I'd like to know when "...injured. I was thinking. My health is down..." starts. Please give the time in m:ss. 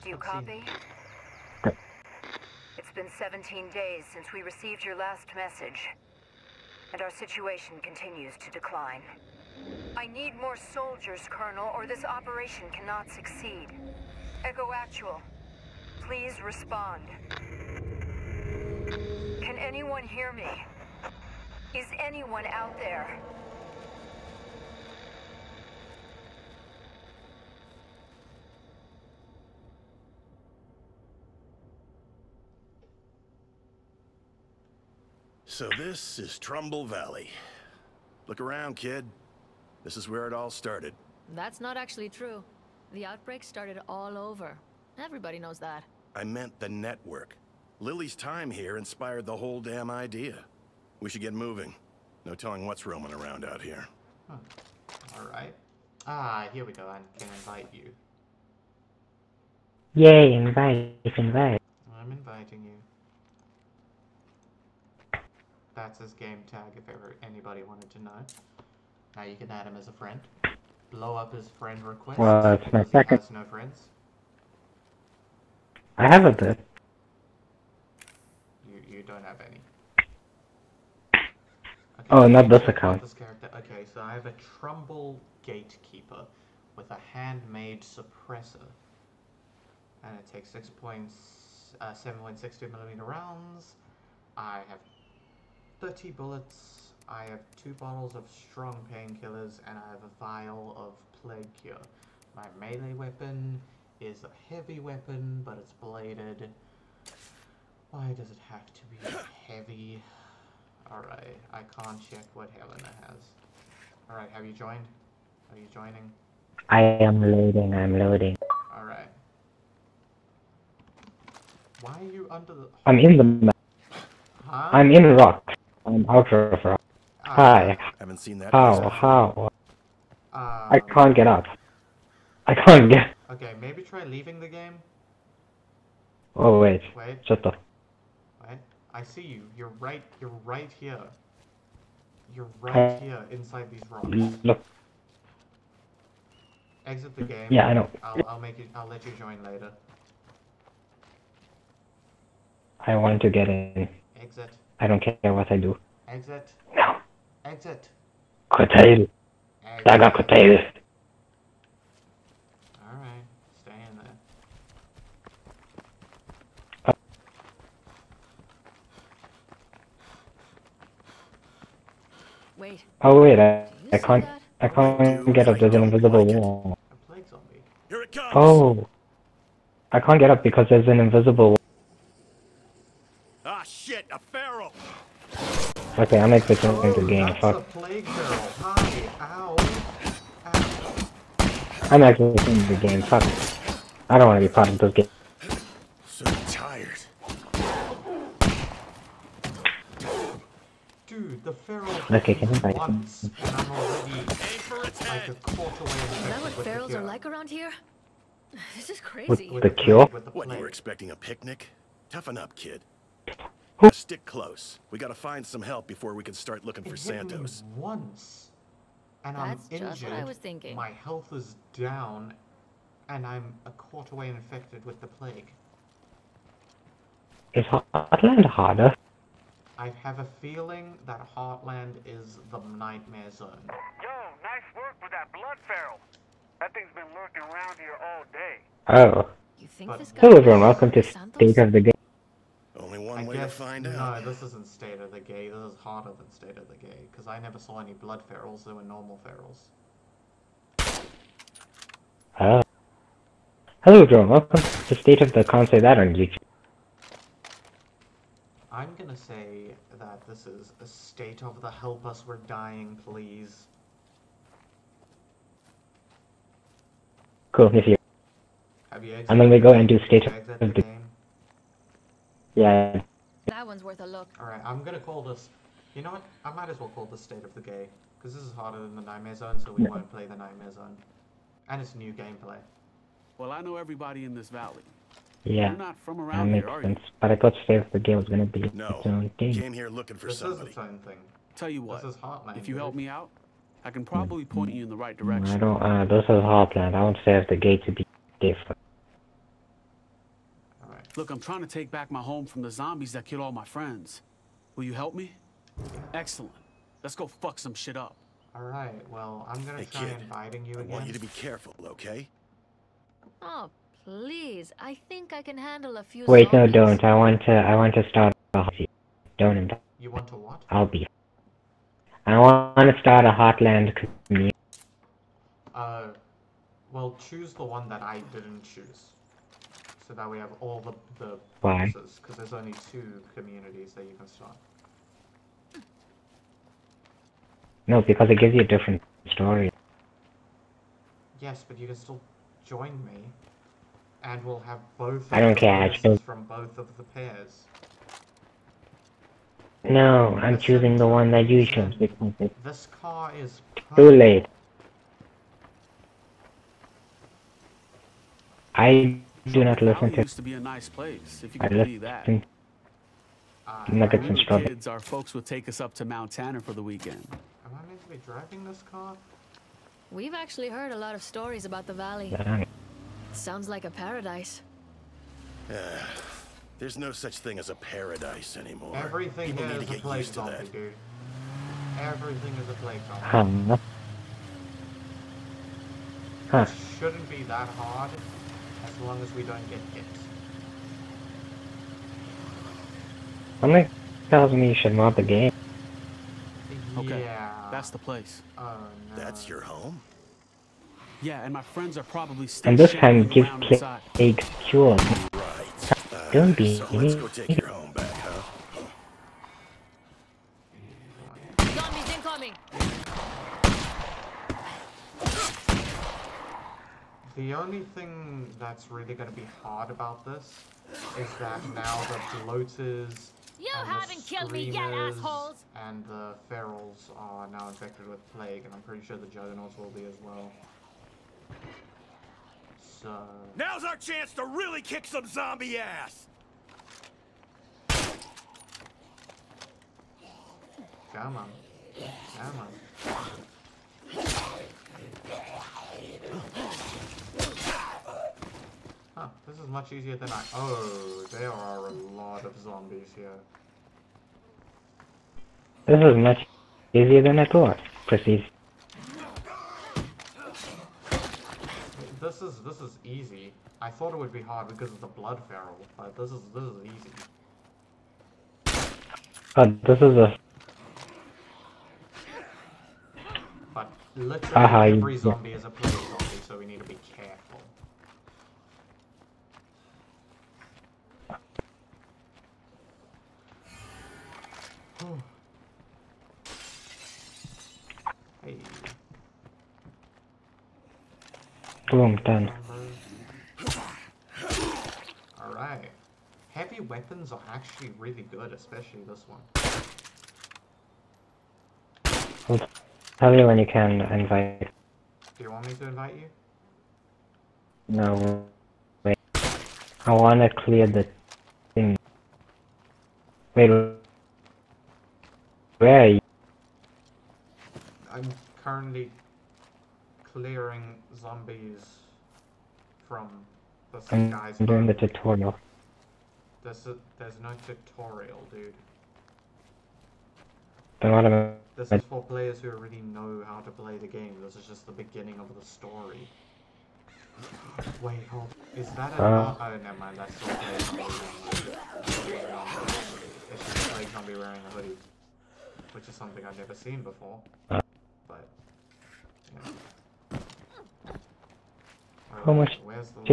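3:39.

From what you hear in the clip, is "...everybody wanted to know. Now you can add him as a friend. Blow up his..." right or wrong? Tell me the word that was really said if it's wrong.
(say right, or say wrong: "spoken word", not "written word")
wrong: "anybody", not "everybody".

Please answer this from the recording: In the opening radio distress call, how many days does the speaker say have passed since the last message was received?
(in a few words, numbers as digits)
17.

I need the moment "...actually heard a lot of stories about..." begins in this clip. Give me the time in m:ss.
6:10.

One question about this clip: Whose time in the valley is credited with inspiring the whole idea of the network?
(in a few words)
Lily.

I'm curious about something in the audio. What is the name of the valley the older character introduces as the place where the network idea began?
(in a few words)
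Trumbull Valley.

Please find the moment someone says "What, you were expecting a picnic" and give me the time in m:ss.
3:30.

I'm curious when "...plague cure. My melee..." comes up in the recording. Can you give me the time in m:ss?
1:41.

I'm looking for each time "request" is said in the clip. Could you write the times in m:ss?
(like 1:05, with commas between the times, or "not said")
1:11.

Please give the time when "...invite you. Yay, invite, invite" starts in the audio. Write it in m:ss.
0:57.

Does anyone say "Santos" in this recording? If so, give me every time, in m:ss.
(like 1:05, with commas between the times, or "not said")
3:36, 4:01.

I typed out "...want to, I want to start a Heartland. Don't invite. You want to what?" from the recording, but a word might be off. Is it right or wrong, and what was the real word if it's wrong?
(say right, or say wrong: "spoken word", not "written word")
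right.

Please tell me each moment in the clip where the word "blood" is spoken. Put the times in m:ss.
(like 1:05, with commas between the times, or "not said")
3:55, 4:07, 7:45.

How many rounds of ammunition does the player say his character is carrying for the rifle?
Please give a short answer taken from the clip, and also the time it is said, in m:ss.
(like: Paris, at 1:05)
30, at 1:35.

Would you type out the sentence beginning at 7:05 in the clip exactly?
And the ferals are now infected with plague, and I'm pretty sure the juggernauts will be as well.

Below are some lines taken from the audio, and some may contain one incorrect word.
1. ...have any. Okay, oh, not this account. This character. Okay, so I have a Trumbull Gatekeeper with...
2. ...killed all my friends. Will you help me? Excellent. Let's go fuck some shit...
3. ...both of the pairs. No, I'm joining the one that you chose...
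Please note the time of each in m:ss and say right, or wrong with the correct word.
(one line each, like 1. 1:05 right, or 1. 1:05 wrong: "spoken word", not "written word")
1. 1:19 right
2. 5:03 right
3. 5:46 wrong: "choosing", not "joining".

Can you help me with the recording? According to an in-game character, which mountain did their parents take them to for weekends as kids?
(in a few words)
Mount Tanner.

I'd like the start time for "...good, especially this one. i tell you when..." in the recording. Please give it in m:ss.
8:18.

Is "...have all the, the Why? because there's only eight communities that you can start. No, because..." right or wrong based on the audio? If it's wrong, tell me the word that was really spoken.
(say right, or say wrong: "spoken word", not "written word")
wrong: "two", not "eight".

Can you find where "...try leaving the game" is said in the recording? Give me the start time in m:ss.
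2:13.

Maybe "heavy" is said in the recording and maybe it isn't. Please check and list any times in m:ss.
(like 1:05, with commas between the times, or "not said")
1:44, 1:49, 8:16.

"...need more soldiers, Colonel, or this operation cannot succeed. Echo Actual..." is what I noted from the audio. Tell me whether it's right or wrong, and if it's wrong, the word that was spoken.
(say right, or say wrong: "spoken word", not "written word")
right.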